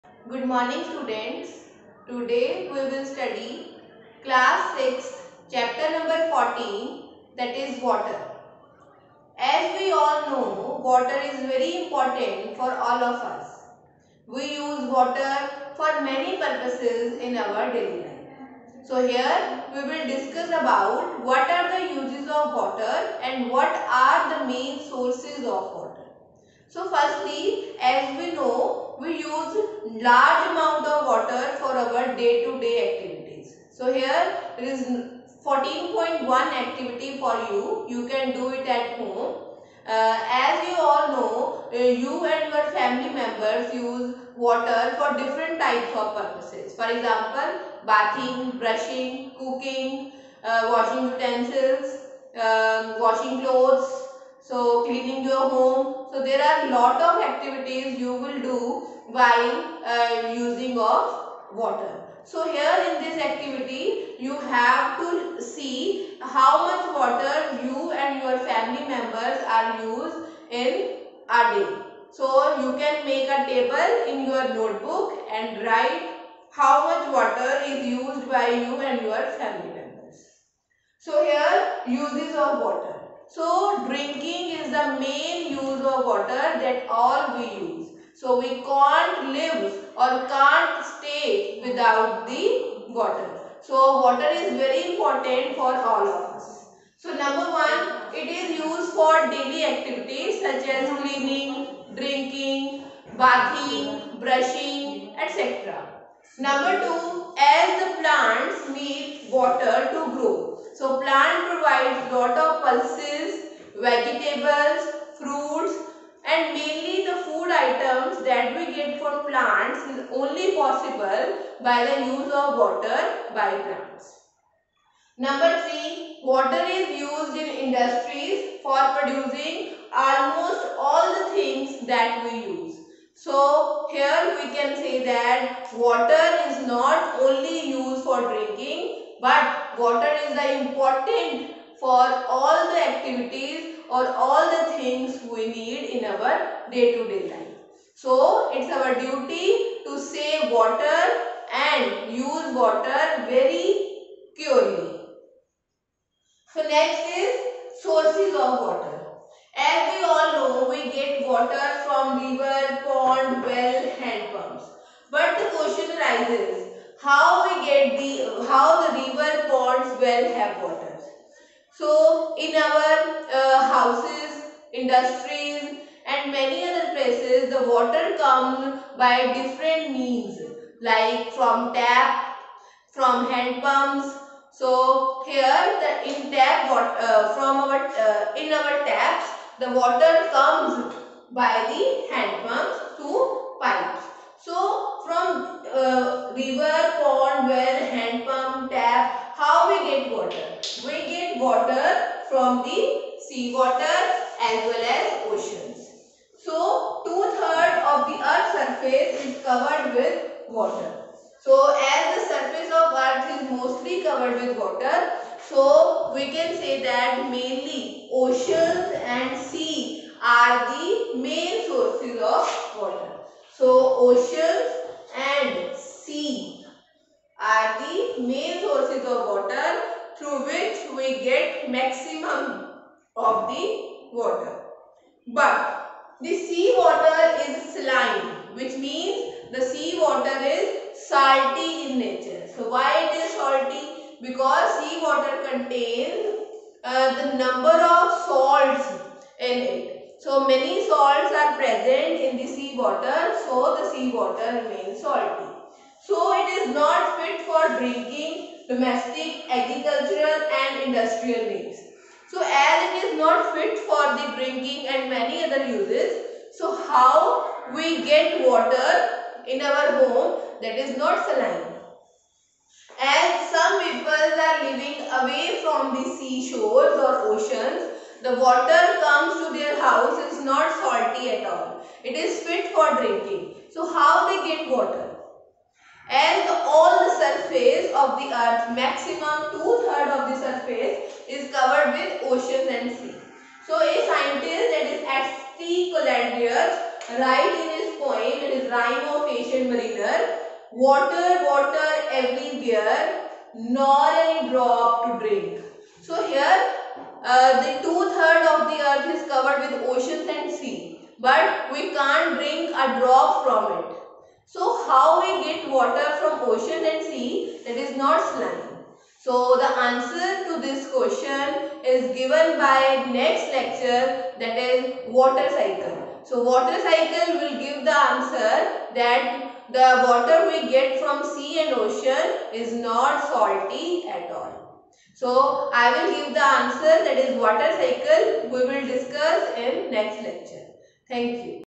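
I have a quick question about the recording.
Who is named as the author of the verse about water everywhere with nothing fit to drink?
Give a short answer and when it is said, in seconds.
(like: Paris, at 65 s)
S.T. Coleridge, at 295 s.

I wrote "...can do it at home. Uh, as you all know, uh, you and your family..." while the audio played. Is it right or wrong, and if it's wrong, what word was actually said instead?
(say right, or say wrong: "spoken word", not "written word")
right.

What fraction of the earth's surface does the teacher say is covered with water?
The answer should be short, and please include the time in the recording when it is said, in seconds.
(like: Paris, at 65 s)
two-thirds, at 207 s.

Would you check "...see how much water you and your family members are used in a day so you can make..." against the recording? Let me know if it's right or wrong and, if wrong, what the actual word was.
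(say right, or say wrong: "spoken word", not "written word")
right.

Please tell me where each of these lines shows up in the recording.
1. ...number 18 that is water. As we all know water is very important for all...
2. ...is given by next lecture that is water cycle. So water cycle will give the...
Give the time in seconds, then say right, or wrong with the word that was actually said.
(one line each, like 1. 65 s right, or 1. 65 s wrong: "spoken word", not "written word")
1. 5 s wrong: "14", not "18"
2. 321 s right.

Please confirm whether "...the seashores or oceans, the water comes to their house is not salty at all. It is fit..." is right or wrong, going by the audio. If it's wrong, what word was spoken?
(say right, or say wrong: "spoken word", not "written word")
right.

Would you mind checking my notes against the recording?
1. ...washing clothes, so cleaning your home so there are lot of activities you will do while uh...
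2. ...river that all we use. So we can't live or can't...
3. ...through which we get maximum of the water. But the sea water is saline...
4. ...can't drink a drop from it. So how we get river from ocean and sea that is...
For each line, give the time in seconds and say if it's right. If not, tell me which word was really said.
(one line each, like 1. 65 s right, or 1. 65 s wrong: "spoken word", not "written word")
1. 53 s right
2. 86 s wrong: "water", not "river"
3. 230 s right
4. 311 s wrong: "water", not "river".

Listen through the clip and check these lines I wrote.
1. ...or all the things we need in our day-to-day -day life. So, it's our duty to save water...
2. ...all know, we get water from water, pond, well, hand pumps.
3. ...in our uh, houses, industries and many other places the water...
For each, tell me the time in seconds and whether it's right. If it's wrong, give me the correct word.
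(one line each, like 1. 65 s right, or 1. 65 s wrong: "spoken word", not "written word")
1. 143 s right
2. 160 s wrong: "river", not "water"
3. 172 s right.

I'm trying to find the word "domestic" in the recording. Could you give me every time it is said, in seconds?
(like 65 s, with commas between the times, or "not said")
258 s.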